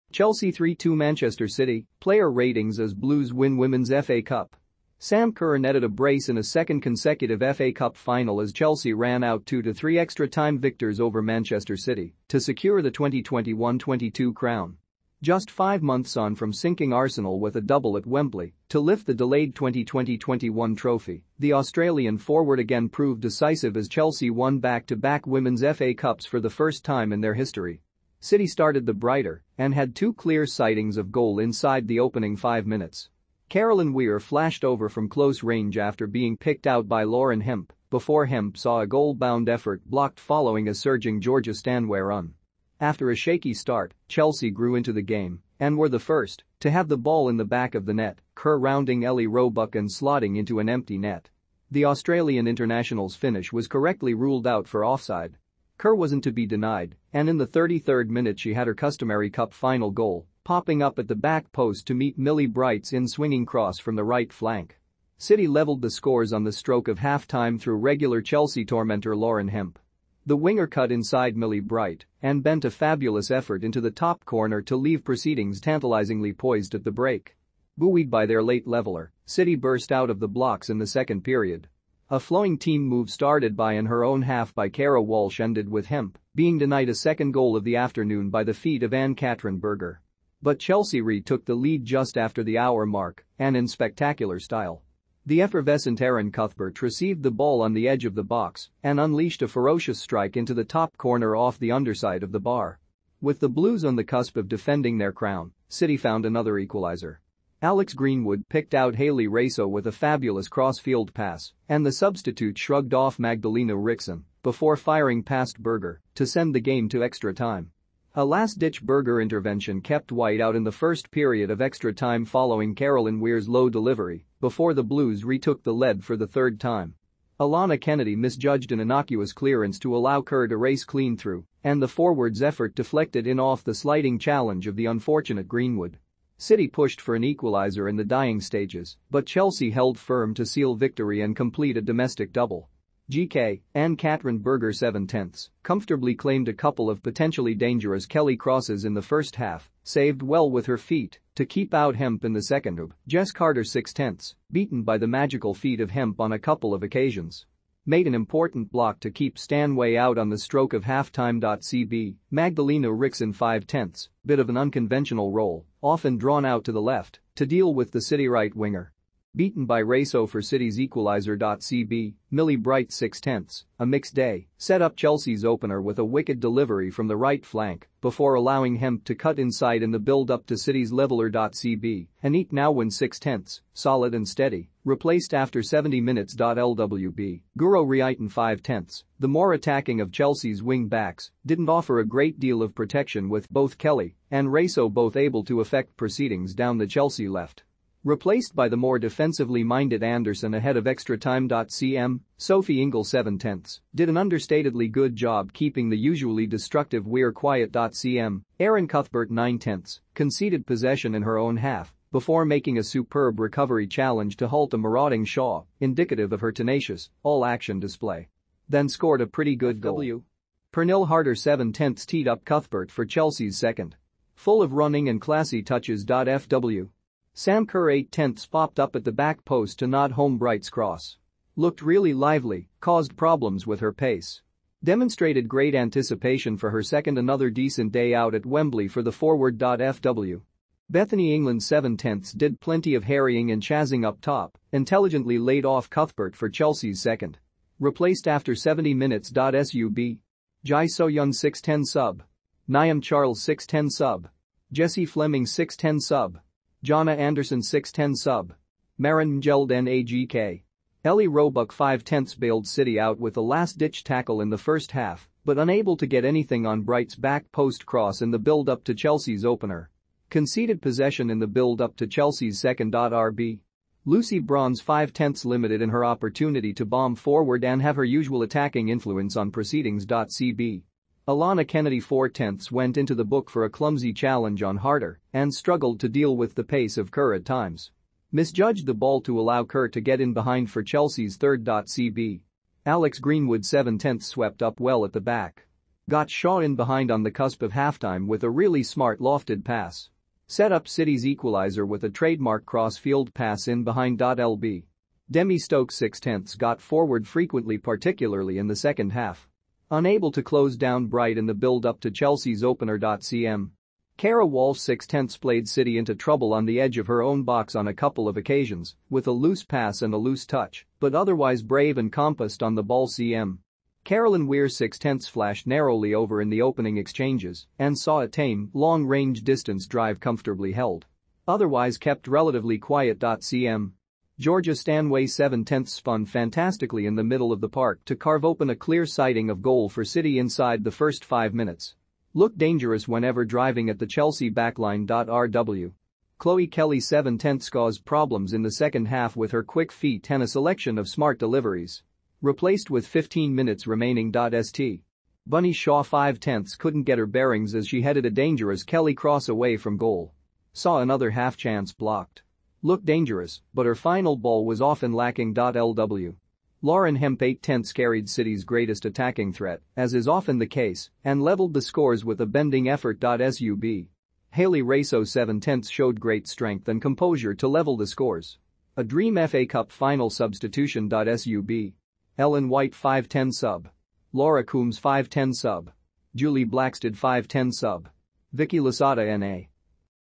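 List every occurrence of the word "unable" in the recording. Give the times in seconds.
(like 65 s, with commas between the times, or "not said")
265 s, 309 s.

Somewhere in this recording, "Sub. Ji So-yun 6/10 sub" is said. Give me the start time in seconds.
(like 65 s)
249 s.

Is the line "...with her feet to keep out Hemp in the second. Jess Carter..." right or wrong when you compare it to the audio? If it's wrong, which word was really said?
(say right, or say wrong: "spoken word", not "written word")
right.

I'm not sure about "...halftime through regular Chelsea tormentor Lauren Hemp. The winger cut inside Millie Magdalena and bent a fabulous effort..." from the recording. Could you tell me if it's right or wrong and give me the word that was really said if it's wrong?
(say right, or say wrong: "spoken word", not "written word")
wrong: "Bright", not "Magdalena".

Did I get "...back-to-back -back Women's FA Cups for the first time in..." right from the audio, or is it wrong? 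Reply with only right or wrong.
right.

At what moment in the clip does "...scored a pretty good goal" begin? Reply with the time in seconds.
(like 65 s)
218 s.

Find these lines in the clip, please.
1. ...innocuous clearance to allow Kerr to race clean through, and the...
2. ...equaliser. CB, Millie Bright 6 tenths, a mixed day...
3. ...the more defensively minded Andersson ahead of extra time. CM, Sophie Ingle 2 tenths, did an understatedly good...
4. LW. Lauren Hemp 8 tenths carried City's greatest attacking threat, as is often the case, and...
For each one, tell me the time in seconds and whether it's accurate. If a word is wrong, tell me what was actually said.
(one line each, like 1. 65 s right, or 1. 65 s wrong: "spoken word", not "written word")
1. 128 s right
2. 170 s right
3. 198 s wrong: "7", not "2"
4. 365 s right.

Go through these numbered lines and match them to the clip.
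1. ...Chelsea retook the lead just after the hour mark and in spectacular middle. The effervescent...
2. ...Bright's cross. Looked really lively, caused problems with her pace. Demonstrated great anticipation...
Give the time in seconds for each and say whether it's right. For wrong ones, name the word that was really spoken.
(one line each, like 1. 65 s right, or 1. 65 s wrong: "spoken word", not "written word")
1. 90 s wrong: "style", not "middle"
2. 230 s right.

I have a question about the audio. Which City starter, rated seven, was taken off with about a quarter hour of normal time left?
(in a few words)
Chloe Kelly.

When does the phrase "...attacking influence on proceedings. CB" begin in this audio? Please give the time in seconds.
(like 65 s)
278 s.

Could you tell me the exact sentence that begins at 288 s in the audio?
Misjudged the ball to allow Kerr to get in behind for Chelsea's third.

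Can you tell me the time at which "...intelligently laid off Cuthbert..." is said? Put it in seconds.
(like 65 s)
244 s.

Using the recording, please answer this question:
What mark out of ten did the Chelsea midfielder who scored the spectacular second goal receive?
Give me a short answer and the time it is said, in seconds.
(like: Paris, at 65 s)
9, at 209 s.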